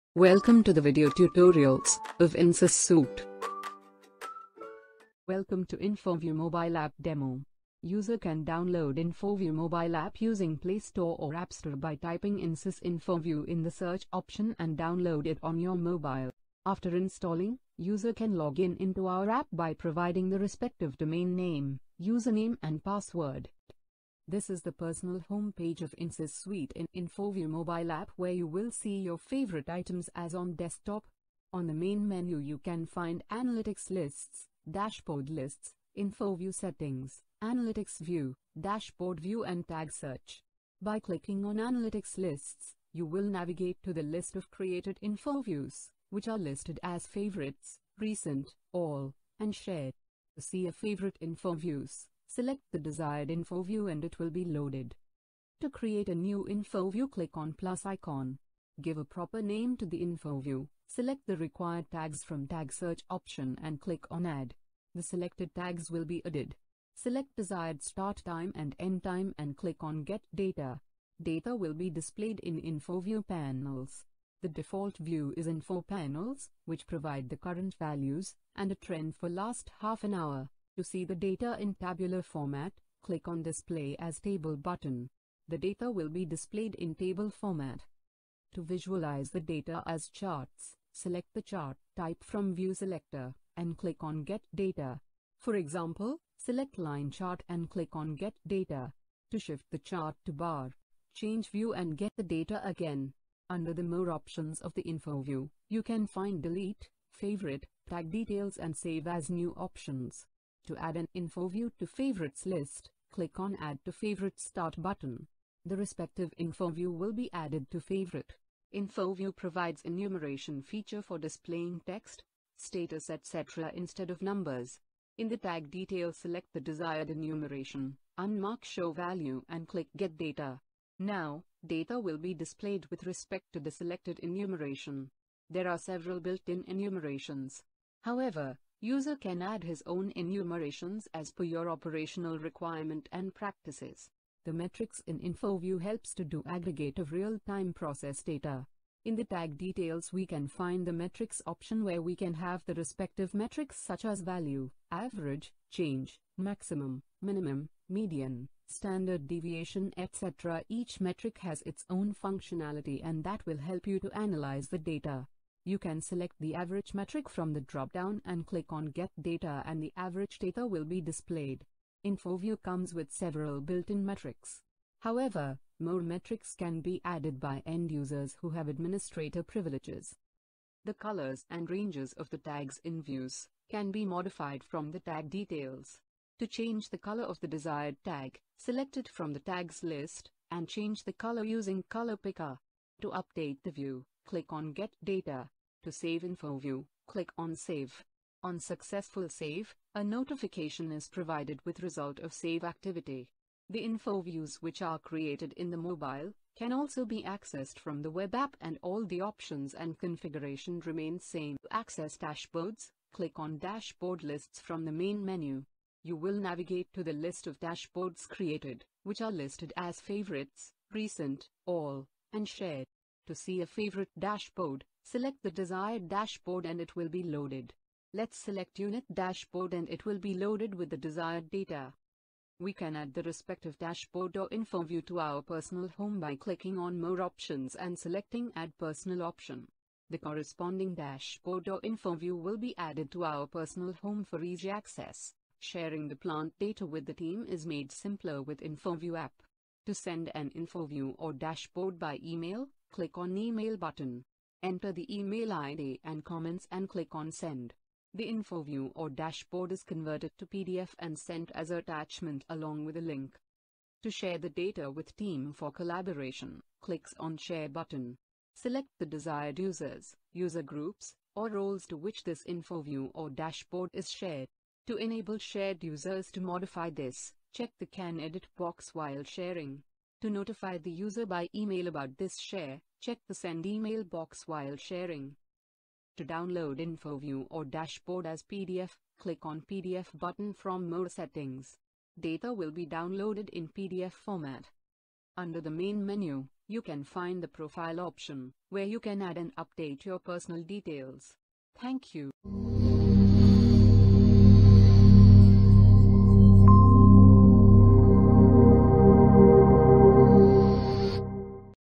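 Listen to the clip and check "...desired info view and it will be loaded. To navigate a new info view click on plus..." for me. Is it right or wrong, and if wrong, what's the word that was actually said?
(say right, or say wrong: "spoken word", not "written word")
wrong: "create", not "navigate".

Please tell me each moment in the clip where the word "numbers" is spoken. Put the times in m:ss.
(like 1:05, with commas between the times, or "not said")
2:04.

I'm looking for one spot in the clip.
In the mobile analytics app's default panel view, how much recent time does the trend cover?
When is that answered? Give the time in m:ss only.
1:19.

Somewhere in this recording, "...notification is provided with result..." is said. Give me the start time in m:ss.
3:20.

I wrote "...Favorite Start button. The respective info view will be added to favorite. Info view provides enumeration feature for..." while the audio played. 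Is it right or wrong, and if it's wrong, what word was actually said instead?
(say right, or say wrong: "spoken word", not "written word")
right.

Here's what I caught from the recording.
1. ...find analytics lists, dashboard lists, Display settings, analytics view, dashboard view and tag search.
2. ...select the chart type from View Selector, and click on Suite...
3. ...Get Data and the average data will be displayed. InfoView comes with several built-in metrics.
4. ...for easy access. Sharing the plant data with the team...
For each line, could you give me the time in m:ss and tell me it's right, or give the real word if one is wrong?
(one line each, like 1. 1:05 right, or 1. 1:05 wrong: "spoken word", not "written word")
1. 0:32 wrong: "InfoView", not "Display"
2. 1:30 wrong: "Get", not "Suite"
3. 2:48 right
4. 4:04 right.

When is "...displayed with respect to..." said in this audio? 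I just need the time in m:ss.
2:12.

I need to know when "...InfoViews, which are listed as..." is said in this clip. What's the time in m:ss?
0:45.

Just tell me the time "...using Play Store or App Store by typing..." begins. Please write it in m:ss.
0:10.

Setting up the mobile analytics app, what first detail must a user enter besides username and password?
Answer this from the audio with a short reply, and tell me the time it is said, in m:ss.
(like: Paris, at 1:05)
domain name, at 0:20.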